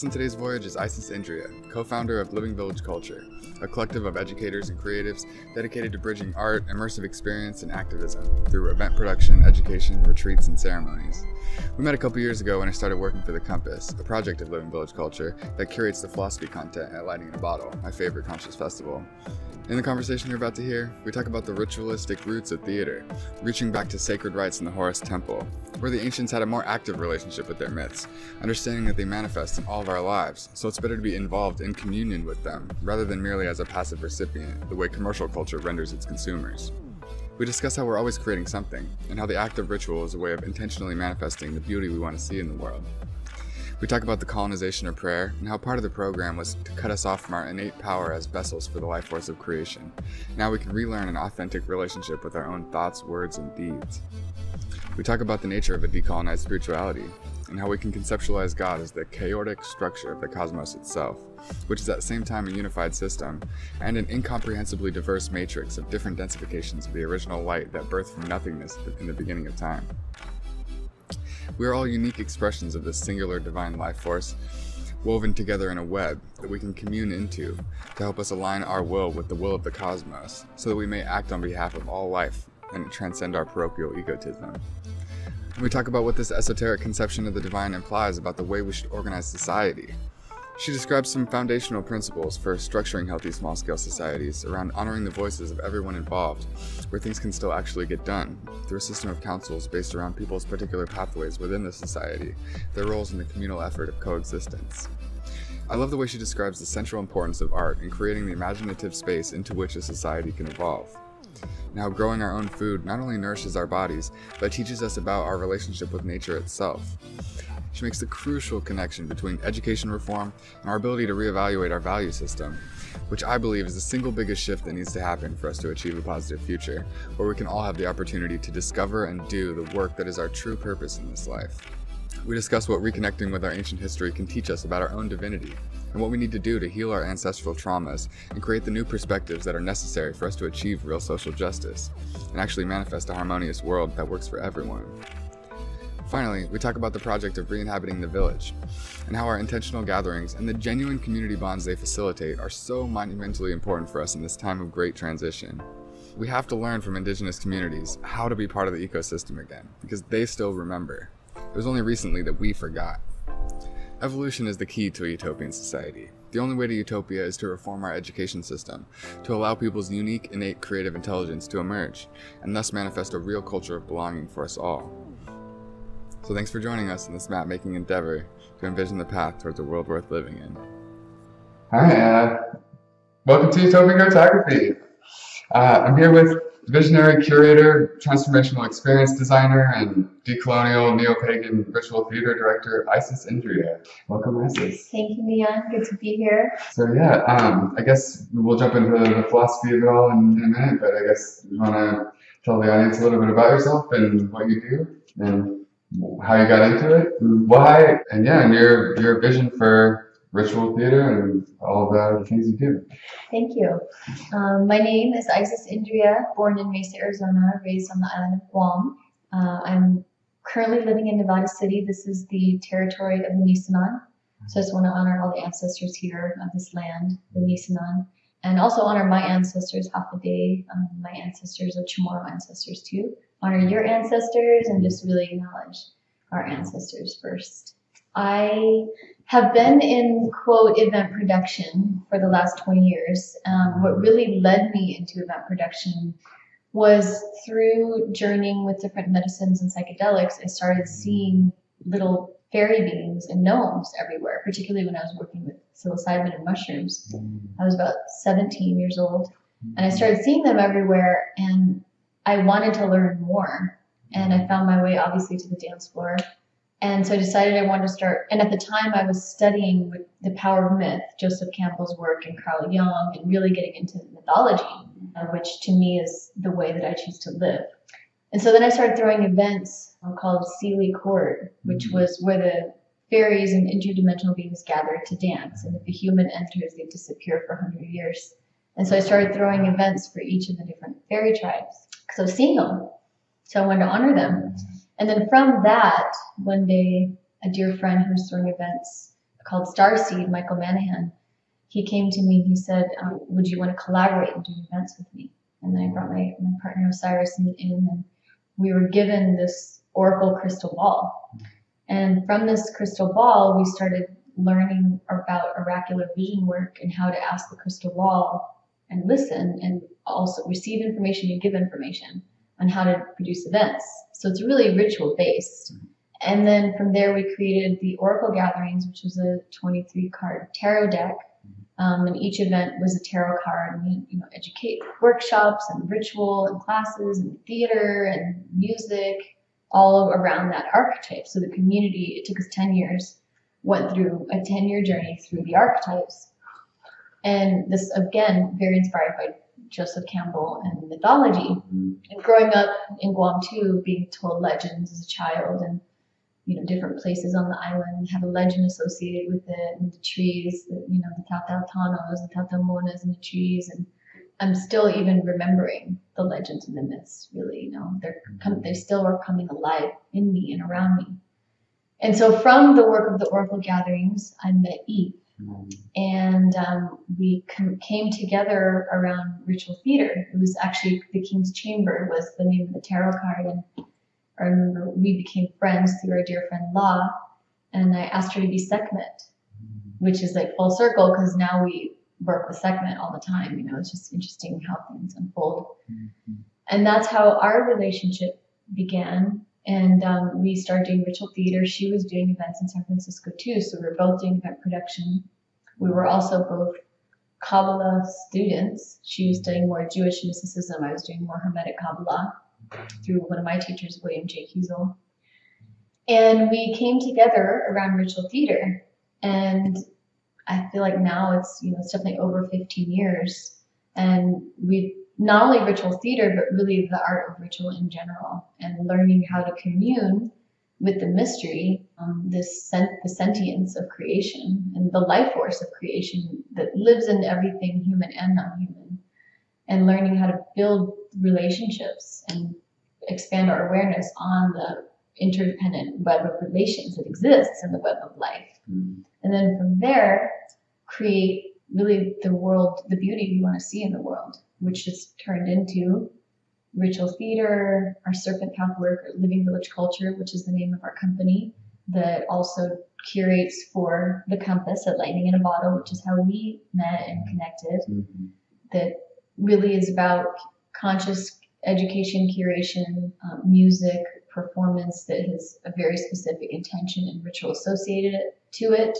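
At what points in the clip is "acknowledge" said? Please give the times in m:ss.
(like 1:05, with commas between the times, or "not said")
3:55.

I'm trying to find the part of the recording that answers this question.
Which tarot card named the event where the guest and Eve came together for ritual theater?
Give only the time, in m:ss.
6:21.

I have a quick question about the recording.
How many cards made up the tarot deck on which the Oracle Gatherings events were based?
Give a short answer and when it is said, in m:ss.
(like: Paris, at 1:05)
23, at 5:29.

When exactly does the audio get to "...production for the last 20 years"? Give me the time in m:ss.
4:01.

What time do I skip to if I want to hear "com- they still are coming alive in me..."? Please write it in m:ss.
6:08.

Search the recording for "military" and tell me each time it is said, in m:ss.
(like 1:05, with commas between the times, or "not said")
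not said.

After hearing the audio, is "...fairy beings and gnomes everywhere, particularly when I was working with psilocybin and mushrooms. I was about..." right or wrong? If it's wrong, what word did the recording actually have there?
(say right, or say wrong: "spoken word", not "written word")
right.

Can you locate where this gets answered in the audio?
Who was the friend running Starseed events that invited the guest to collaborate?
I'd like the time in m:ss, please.
5:00.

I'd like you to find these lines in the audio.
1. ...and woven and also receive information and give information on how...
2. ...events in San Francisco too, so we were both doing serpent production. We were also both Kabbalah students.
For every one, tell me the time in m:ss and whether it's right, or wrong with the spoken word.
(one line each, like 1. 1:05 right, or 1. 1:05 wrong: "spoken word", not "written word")
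1. 5:18 wrong: "listen", not "woven"
2. 6:42 wrong: "event", not "serpent".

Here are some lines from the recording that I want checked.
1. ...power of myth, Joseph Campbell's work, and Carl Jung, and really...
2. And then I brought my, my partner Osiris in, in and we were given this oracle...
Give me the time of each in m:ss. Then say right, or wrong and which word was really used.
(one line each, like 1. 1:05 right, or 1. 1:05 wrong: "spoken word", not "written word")
1. 4:30 right
2. 5:05 right.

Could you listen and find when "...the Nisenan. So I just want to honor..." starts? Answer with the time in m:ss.
3:43.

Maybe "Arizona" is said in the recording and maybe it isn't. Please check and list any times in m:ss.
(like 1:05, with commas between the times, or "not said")
3:36.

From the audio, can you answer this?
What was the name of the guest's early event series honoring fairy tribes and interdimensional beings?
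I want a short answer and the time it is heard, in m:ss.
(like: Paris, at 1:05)
Seelie Court, at 4:40.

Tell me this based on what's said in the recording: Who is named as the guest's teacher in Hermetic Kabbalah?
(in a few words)
William J. Kiesel.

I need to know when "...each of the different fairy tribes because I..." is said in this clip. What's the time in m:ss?
4:50.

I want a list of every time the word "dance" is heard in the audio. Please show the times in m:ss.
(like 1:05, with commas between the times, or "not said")
4:25, 4:45.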